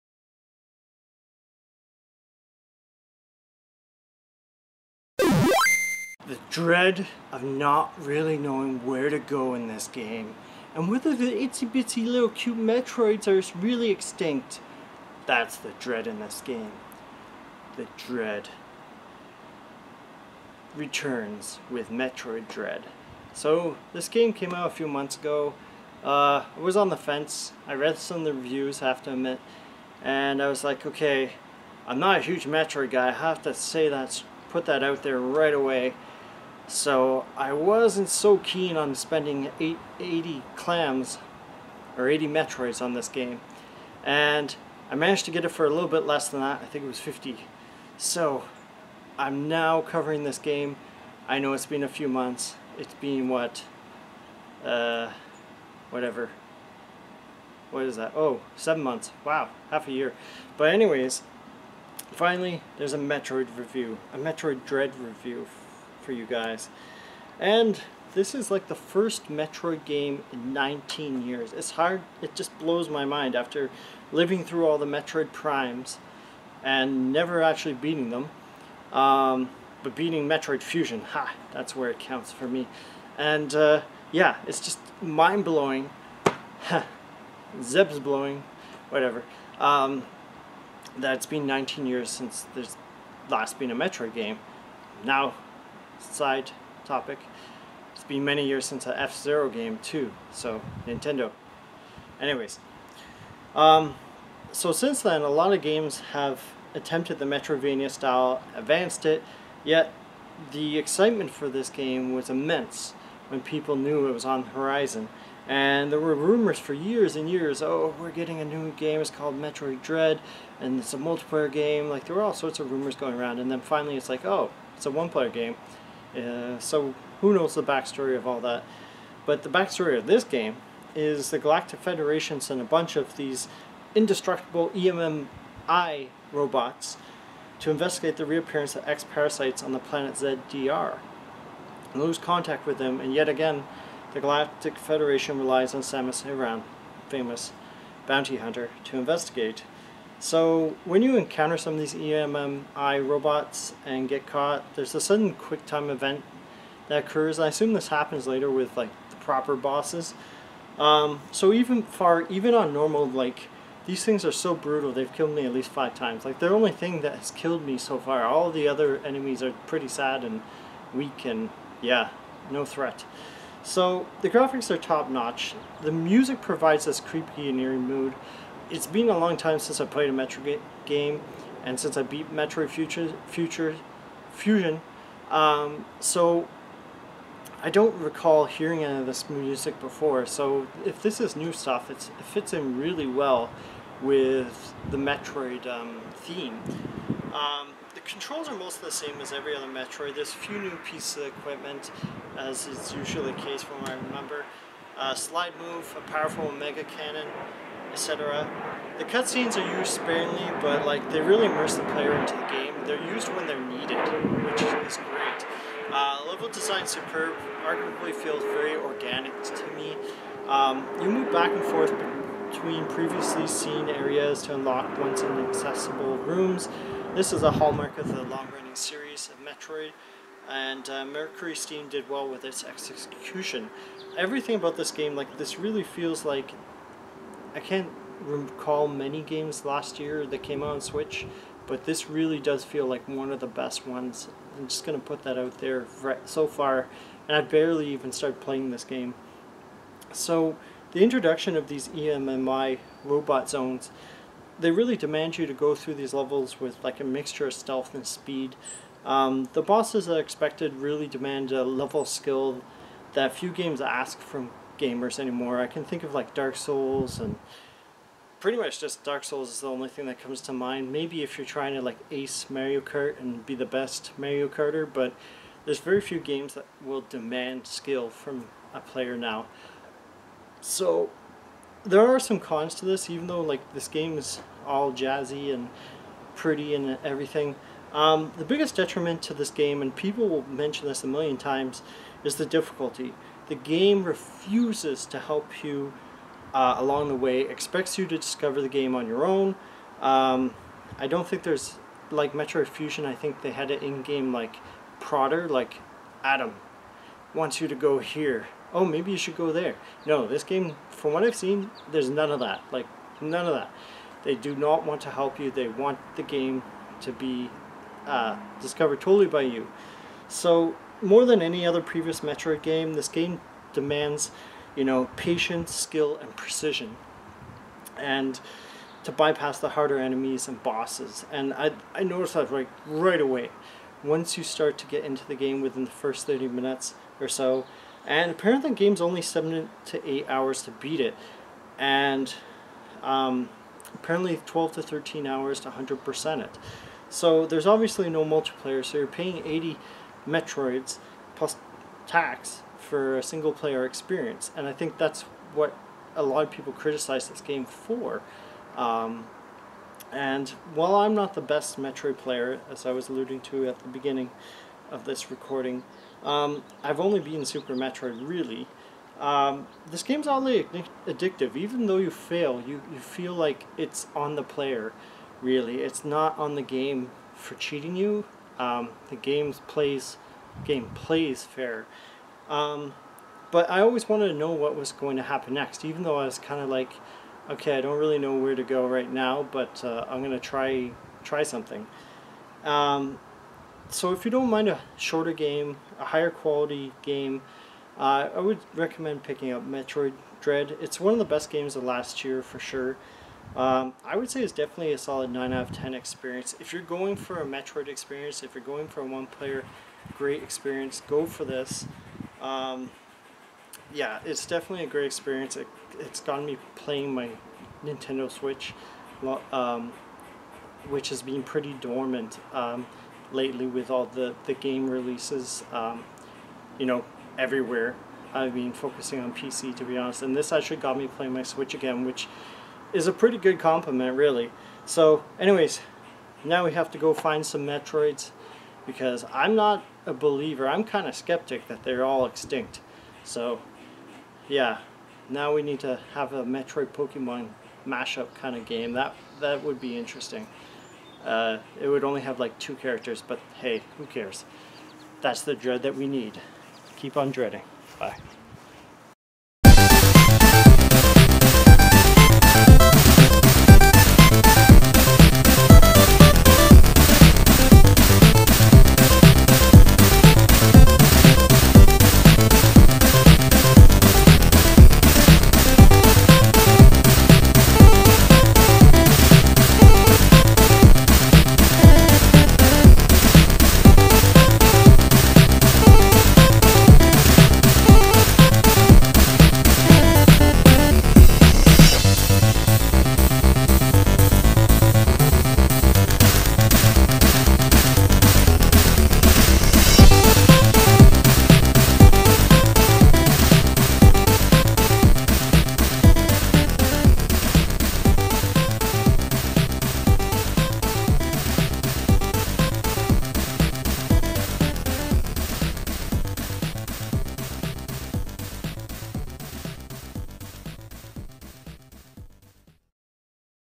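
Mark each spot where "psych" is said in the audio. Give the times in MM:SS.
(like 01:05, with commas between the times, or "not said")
not said.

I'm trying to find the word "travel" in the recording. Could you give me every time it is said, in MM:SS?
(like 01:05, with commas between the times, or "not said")
not said.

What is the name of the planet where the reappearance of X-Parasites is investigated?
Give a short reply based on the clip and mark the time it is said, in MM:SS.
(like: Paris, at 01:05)
ZDR, at 02:20.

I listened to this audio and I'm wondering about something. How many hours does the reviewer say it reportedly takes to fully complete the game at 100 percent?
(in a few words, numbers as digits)
12 to 13 hours.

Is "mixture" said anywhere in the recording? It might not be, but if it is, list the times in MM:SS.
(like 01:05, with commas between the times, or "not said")
04:17.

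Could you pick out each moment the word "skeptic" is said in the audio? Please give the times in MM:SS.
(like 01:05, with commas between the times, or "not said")
07:21.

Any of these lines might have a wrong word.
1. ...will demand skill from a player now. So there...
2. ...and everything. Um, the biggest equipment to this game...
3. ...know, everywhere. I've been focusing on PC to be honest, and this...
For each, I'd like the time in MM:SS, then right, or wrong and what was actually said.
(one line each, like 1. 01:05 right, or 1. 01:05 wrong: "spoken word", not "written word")
1. 04:36 right
2. 04:46 wrong: "detriment", not "equipment"
3. 07:06 right.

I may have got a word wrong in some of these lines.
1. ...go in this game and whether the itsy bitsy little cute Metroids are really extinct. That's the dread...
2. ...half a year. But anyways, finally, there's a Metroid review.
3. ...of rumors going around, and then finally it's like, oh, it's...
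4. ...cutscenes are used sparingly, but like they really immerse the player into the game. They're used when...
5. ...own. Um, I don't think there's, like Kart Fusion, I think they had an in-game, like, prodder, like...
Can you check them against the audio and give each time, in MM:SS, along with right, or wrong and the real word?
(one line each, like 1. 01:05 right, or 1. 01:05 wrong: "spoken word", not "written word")
1. 00:09 right
2. 00:59 right
3. 02:02 right
4. 03:29 right
5. 04:59 wrong: "Metroid", not "Kart".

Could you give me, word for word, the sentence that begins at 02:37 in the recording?
I assume this happens later with like the proper bosses.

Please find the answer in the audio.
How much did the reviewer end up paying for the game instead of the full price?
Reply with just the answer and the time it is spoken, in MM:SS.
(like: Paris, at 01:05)
50, at 00:46.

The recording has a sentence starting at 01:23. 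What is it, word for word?
And uh, yeah, it's just mind-blowing.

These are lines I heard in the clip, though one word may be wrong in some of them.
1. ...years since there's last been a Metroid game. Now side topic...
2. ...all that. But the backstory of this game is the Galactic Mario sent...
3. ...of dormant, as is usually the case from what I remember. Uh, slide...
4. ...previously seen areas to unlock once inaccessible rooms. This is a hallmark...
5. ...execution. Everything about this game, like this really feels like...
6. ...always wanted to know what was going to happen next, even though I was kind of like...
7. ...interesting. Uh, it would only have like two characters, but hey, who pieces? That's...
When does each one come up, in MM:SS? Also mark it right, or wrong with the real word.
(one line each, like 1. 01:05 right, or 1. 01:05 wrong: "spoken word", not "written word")
1. 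01:31 right
2. 02:08 wrong: "Federation", not "Mario"
3. 03:21 wrong: "equipment", not "dormant"
4. 03:42 right
5. 03:52 right
6. 06:23 right
7. 07:29 wrong: "cares", not "pieces".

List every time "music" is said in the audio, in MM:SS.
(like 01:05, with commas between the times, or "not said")
02:55, 03:09.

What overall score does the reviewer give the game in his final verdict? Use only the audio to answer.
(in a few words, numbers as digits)
9 out of 10.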